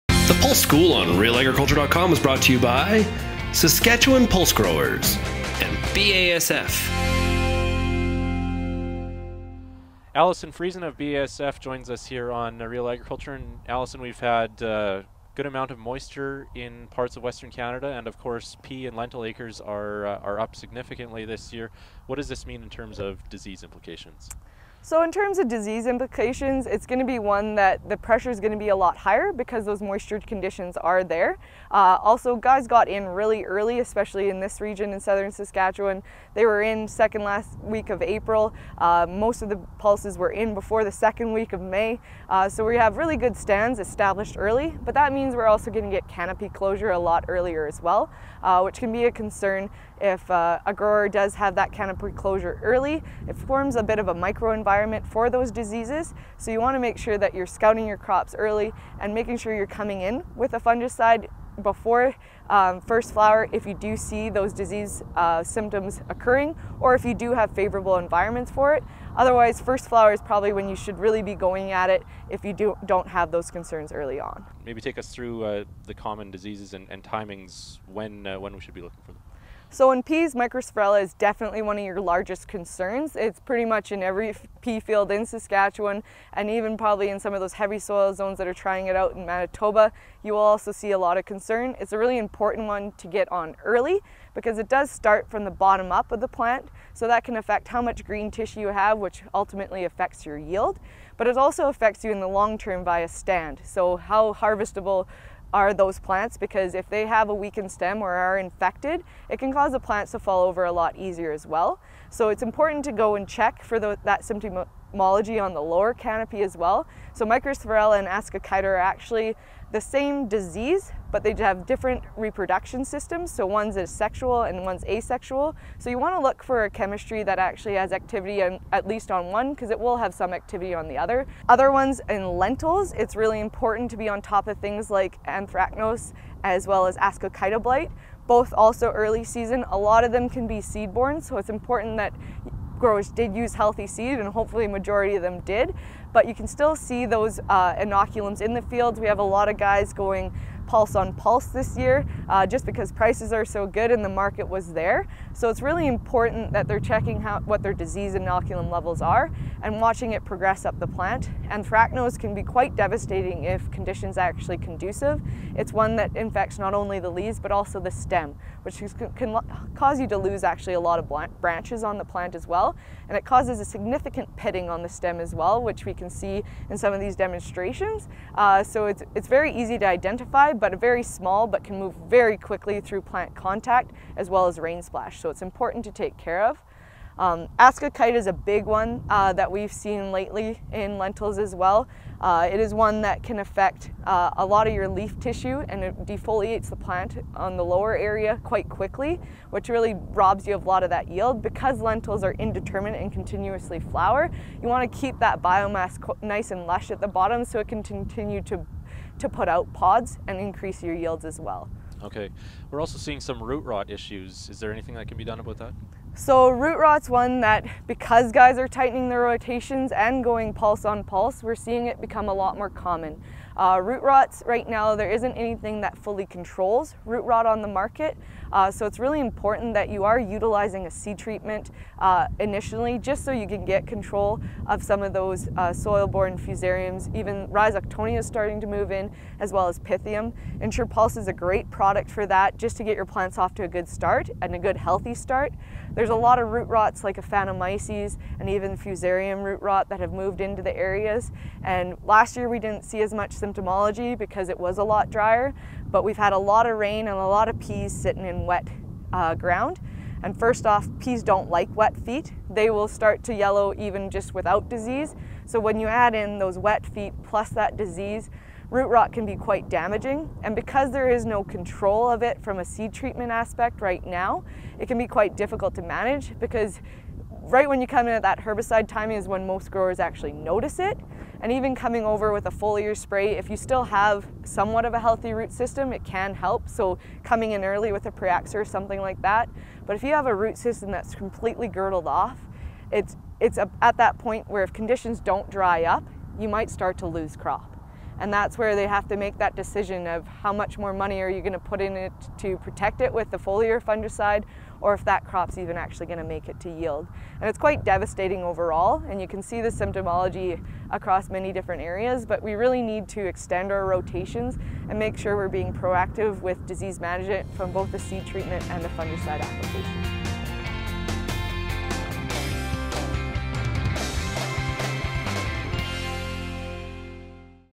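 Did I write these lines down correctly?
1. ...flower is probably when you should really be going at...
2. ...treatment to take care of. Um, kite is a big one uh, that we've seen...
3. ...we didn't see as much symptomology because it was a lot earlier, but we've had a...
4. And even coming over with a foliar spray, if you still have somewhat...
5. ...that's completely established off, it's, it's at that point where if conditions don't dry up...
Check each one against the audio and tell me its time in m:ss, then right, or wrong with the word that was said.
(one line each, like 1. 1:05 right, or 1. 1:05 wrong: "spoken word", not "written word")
1. 1:09 right
2. 3:05 wrong: "important", not "treatment"
3. 4:12 wrong: "drier", not "earlier"
4. 4:41 right
5. 4:50 wrong: "girdled", not "established".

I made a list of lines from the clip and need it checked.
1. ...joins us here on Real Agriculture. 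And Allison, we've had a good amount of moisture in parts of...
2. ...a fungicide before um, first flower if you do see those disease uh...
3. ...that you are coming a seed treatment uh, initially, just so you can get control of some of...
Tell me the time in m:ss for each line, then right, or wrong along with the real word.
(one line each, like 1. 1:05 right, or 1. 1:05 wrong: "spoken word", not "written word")
1. 0:11 right
2. 1:00 right
3. 3:49 wrong: "utilizing", not "coming".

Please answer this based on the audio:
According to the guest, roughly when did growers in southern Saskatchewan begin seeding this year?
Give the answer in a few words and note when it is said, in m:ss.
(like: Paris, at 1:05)
Second last week of April, at 0:36.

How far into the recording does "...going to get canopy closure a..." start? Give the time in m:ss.
0:45.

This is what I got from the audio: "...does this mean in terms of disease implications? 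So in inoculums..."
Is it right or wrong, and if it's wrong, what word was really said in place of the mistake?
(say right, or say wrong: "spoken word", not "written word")
wrong: "terms", not "inoculums".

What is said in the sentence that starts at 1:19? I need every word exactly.
So in peas, mycosphaerella is definitely one of your largest concerns.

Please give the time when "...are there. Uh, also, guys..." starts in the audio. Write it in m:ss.
0:30.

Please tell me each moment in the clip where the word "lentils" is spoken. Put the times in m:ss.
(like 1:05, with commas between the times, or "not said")
0:18, 2:12, 3:10, 3:21.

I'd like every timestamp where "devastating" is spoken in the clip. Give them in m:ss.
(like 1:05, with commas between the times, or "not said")
2:42, 5:07.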